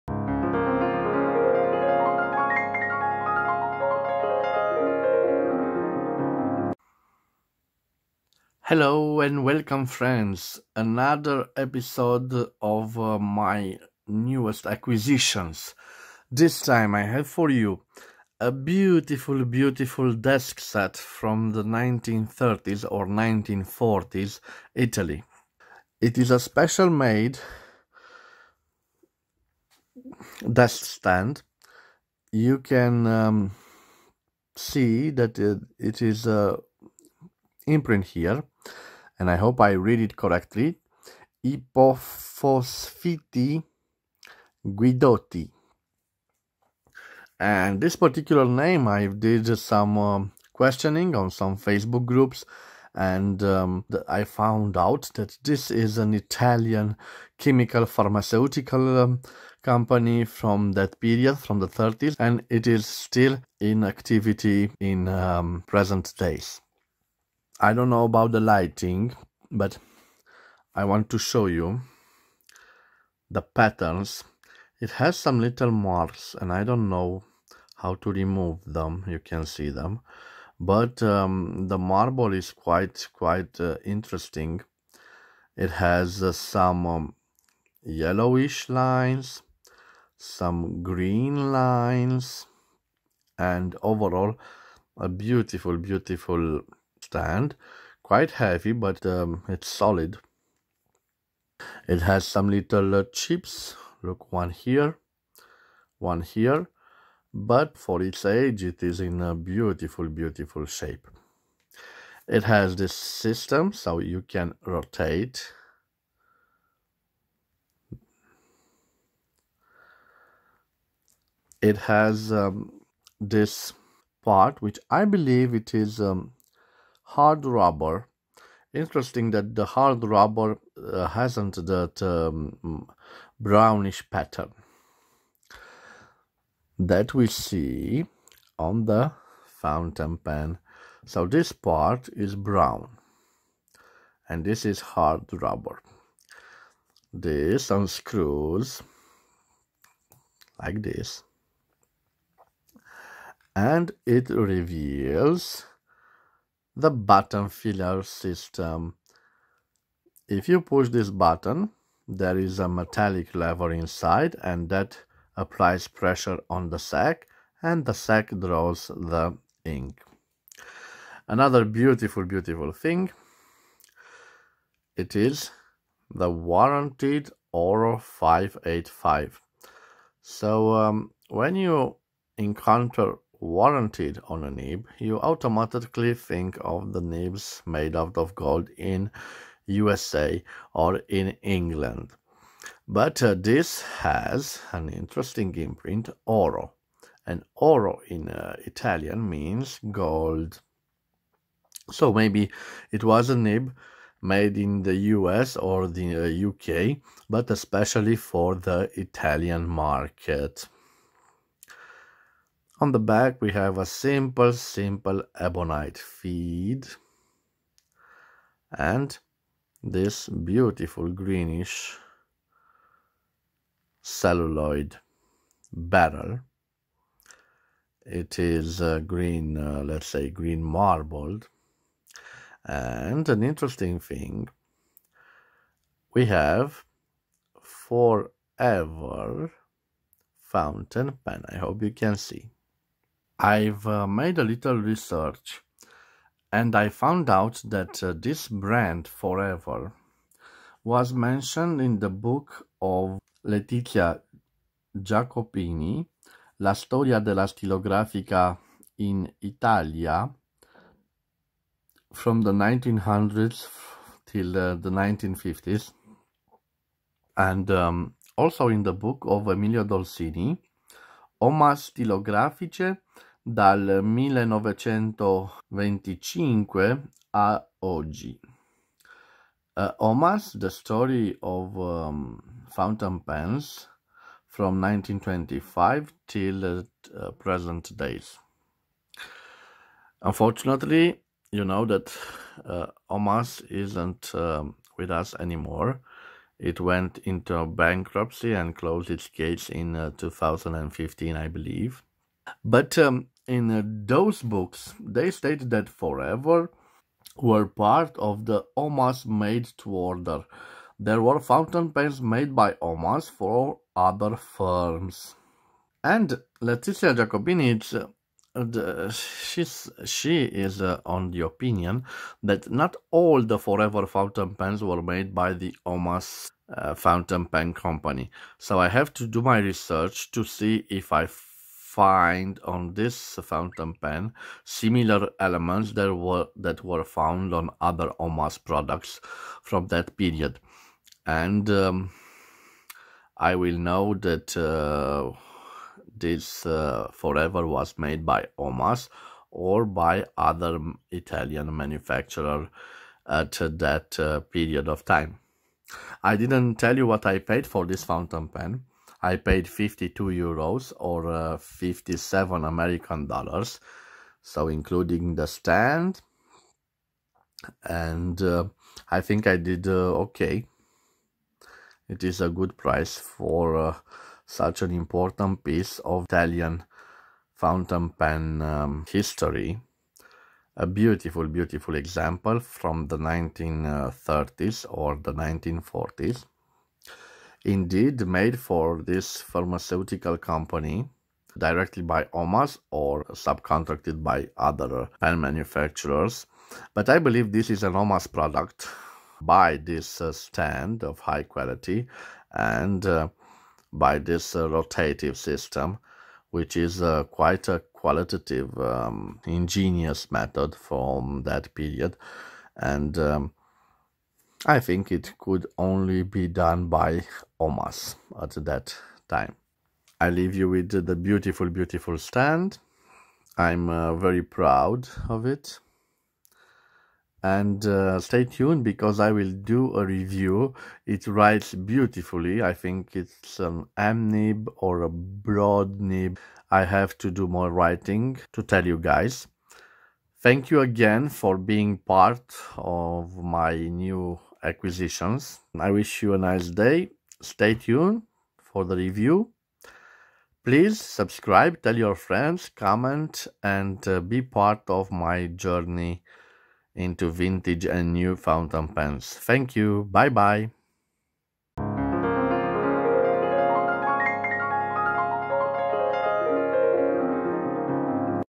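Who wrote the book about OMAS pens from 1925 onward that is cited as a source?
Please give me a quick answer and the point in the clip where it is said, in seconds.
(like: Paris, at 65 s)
Emilio Dolcini, at 269 s.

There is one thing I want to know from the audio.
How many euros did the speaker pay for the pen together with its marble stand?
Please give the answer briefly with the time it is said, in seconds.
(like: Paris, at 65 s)
52 euros, at 359 s.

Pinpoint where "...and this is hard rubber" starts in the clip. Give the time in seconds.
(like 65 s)
144 s.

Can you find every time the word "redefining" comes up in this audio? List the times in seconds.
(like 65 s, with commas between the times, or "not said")
not said.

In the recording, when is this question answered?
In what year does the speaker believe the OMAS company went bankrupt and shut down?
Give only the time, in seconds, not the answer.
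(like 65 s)
300 s.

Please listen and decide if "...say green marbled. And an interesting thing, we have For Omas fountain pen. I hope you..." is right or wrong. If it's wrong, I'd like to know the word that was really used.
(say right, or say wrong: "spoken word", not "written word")
wrong: "Ever", not "Omas".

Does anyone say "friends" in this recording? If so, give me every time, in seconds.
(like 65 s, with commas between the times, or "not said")
9 s, 452 s.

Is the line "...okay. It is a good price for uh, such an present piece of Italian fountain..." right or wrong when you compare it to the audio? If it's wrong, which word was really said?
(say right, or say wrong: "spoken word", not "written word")
wrong: "important", not "present".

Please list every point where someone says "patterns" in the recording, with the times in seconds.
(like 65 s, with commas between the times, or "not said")
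73 s, 134 s.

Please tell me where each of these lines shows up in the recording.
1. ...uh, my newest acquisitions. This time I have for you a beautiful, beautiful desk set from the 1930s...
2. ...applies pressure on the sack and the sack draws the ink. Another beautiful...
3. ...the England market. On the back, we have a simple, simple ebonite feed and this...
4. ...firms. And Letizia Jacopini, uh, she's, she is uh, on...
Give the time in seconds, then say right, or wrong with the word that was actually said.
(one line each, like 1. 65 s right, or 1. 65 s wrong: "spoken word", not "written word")
1. 12 s right
2. 165 s right
3. 208 s wrong: "Italian", not "England"
4. 314 s right.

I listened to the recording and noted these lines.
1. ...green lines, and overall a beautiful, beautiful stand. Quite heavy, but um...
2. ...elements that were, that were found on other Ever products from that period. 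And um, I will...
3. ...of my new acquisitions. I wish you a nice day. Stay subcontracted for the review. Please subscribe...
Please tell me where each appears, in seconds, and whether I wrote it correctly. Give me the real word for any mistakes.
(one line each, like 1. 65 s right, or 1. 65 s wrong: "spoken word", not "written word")
1. 90 s right
2. 335 s wrong: "OMAS", not "Ever"
3. 442 s wrong: "tuned", not "subcontracted".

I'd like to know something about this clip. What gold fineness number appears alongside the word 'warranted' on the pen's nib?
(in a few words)
585.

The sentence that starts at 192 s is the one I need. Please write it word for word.
But uh, this has an interesting imprint, oro.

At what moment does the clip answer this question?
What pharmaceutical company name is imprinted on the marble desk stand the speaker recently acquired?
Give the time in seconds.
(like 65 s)
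41 s.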